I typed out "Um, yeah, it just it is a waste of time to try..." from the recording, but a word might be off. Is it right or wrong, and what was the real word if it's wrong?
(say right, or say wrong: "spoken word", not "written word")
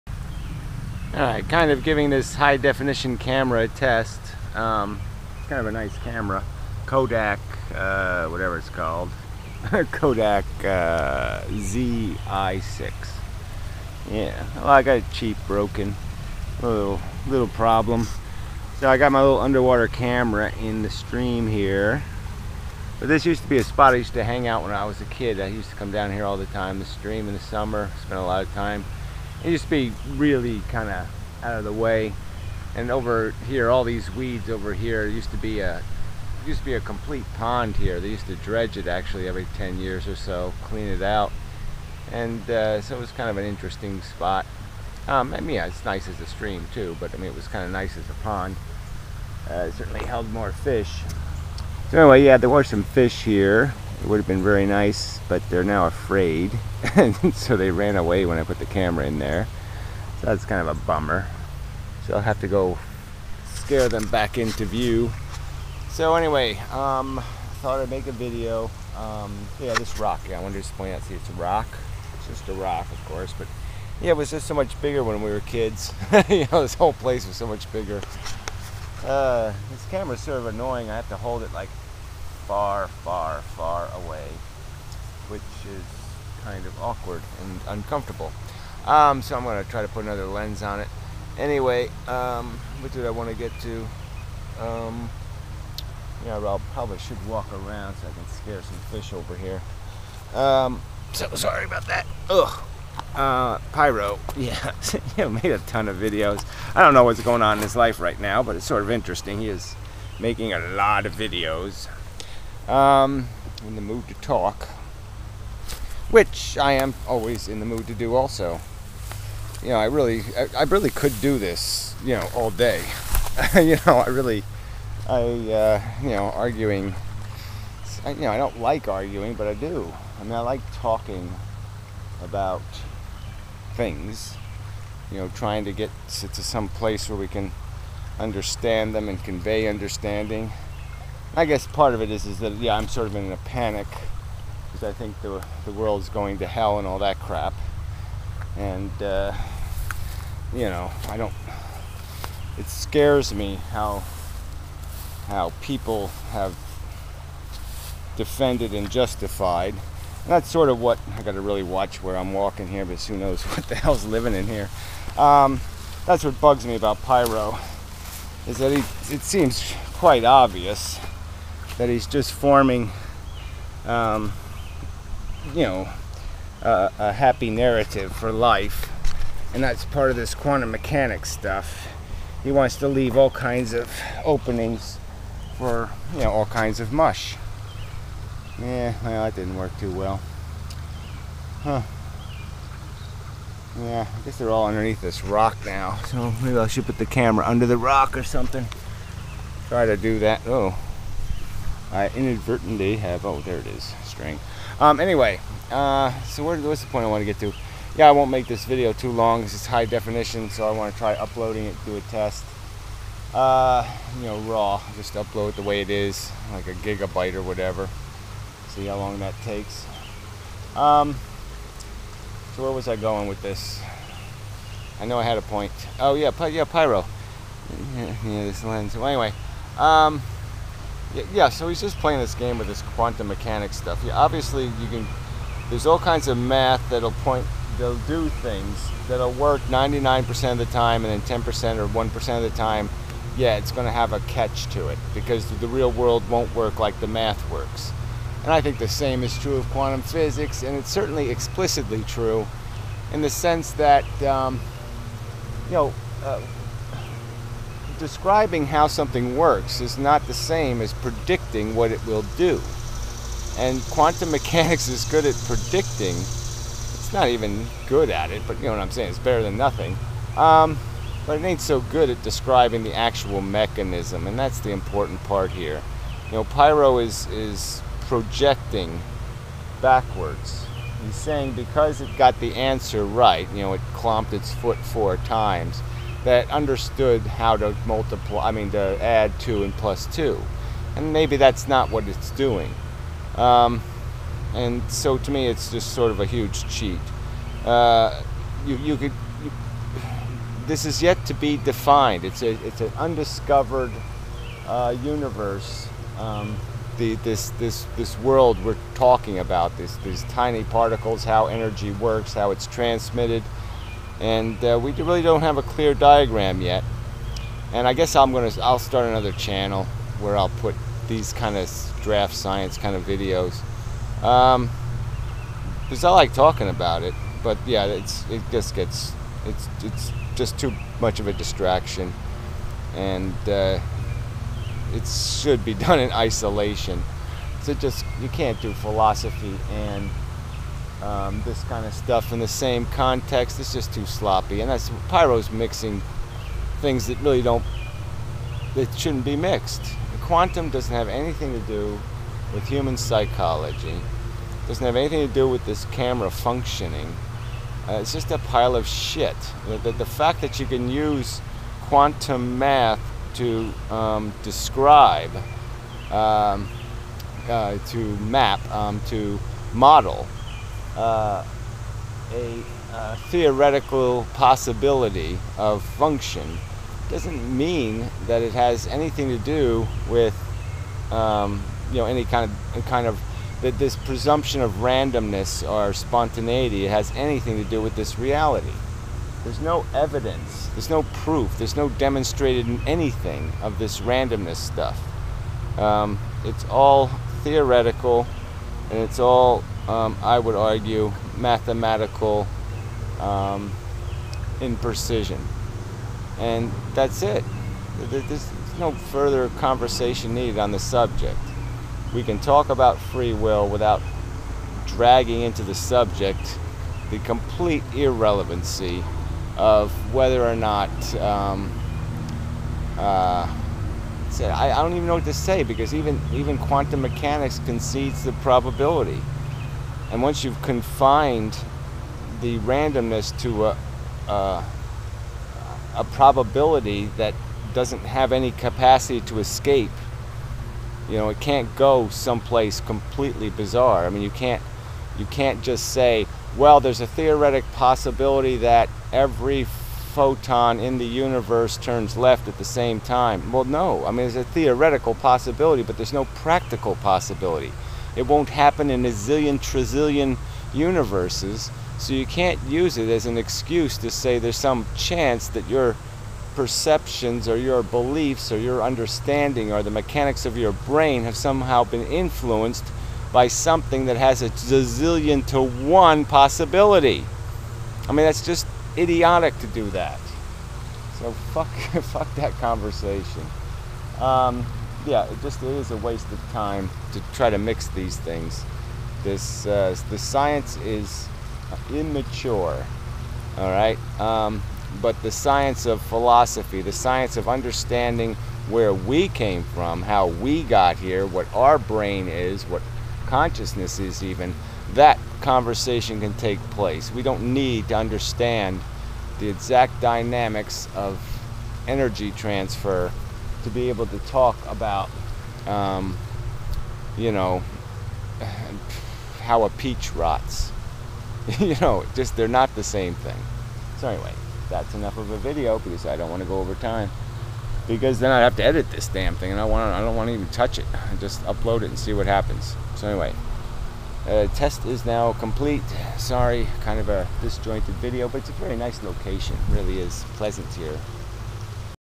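right.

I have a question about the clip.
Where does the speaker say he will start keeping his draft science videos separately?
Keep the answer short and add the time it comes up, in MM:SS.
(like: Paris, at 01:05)
Another channel, at 05:19.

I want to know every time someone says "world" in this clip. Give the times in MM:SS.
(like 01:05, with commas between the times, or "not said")
02:25, 04:05, 05:08.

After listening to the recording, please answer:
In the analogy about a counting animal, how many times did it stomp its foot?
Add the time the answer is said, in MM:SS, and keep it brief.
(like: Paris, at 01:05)
4, at 04:44.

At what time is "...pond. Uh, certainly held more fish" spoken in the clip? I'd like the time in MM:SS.
00:48.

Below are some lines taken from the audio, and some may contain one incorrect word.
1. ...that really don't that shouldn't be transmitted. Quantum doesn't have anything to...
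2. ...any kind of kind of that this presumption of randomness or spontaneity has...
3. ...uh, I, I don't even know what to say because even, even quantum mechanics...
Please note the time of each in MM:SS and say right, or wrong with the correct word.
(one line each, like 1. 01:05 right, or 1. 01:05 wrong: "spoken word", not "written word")
1. 05:47 wrong: "mixed", not "transmitted"
2. 06:22 right
3. 07:02 right.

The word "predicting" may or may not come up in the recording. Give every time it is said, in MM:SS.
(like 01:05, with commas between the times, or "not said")
04:20, 04:25.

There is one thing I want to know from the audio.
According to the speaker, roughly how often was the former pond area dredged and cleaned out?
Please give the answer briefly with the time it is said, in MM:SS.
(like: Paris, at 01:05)
Every 10 years, at 00:39.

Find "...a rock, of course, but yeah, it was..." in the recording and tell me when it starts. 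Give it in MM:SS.
01:12.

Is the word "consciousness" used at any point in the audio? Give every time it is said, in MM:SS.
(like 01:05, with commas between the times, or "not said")
08:23.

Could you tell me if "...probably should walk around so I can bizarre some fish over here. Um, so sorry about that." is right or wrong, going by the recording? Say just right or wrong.
wrong.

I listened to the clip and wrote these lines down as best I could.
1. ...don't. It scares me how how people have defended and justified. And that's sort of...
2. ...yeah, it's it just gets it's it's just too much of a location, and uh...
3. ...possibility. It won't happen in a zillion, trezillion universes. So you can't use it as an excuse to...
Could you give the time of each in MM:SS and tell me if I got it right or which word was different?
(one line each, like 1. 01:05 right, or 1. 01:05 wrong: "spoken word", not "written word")
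1. 02:31 right
2. 05:27 wrong: "distraction", not "location"
3. 07:36 right.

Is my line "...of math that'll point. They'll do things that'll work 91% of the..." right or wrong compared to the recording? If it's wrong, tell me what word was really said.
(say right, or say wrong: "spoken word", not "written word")
wrong: "99", not "91".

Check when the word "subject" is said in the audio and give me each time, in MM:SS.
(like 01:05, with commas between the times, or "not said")
06:50, 06:55.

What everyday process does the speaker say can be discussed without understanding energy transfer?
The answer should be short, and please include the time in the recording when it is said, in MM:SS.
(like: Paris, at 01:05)
How a peach rots, at 08:39.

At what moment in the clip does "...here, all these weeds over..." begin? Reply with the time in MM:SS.
00:33.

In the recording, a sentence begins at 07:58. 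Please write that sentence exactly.
I mean, that's just idiotic to do that.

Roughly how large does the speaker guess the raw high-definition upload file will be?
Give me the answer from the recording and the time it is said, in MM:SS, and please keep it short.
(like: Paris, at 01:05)
A gigabyte, at 03:36.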